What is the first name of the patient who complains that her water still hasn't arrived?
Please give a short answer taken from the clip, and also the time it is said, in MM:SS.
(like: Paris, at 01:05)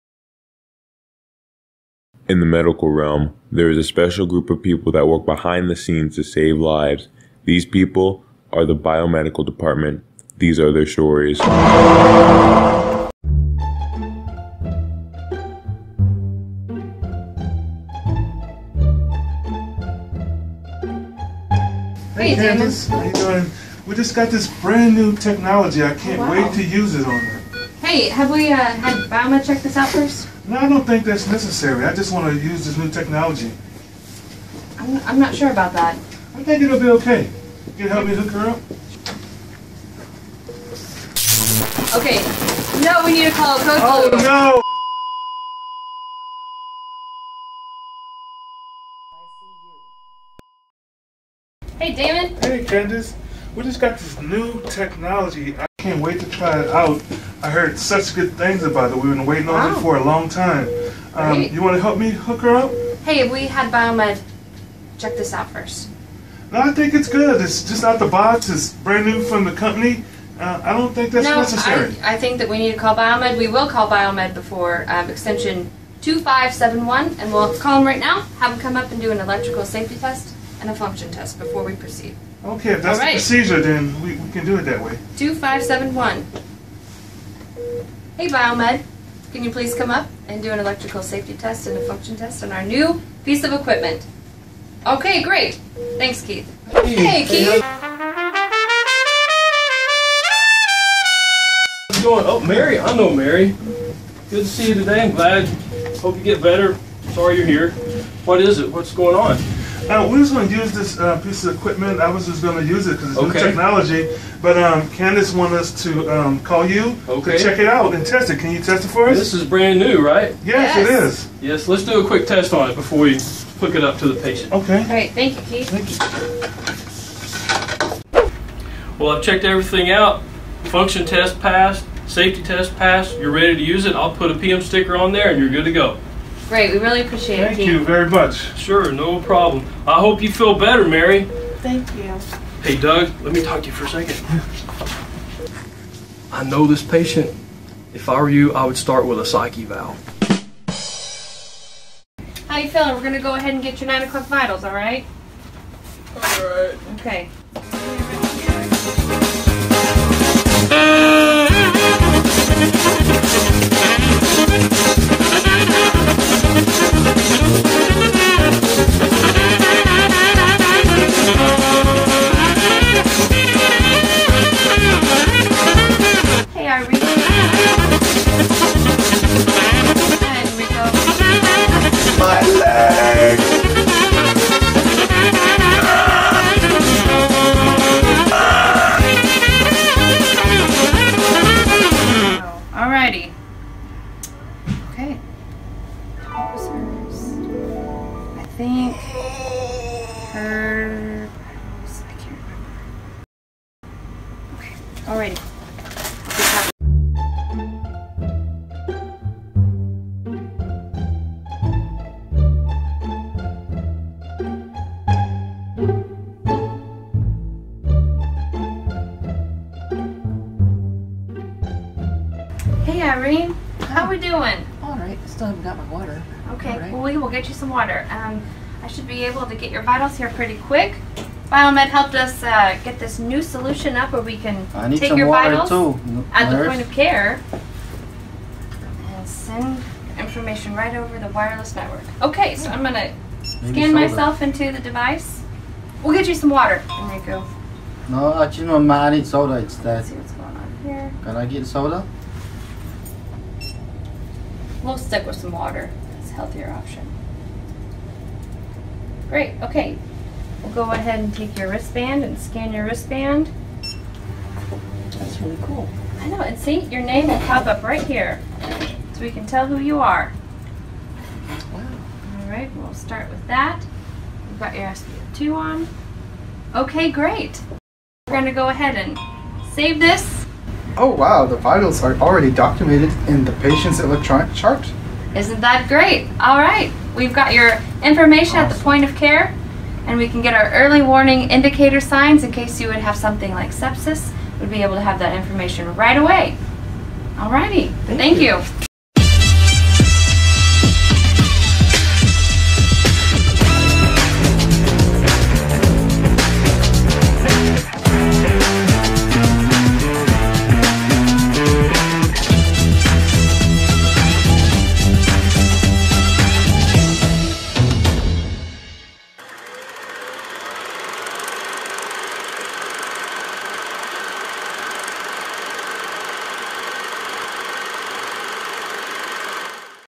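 Irene, at 03:43.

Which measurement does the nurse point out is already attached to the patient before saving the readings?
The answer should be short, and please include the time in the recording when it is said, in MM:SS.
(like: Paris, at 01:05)
SpO2, at 04:34.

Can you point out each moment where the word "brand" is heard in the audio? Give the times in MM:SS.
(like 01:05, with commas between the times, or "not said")
00:24, 01:08, 01:59.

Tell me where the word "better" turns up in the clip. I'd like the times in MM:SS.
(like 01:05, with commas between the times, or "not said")
01:46, 02:20.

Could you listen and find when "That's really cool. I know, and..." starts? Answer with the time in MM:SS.
04:25.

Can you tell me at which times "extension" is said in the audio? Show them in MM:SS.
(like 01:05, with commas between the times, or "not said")
01:15.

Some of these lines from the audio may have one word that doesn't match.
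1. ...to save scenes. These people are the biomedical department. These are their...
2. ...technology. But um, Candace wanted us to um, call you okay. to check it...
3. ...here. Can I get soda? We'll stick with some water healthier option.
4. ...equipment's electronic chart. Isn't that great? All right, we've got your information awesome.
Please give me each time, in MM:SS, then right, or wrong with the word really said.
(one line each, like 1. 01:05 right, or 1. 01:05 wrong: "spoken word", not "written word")
1. 00:06 wrong: "lives", not "scenes"
2. 01:53 right
3. 04:10 right
4. 04:43 wrong: "patient", not "equipment".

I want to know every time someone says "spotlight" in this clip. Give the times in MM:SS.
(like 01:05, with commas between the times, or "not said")
not said.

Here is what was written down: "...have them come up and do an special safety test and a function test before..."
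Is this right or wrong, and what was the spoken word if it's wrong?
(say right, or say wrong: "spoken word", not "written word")
wrong: "electrical", not "special".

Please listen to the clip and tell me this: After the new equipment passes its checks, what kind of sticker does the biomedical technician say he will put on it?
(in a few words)
PM sticker.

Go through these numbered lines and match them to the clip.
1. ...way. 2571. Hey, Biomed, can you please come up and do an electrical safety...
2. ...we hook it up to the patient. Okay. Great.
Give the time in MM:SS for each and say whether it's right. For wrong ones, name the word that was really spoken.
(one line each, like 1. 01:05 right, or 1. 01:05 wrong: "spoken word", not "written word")
1. 01:24 right
2. 02:02 right.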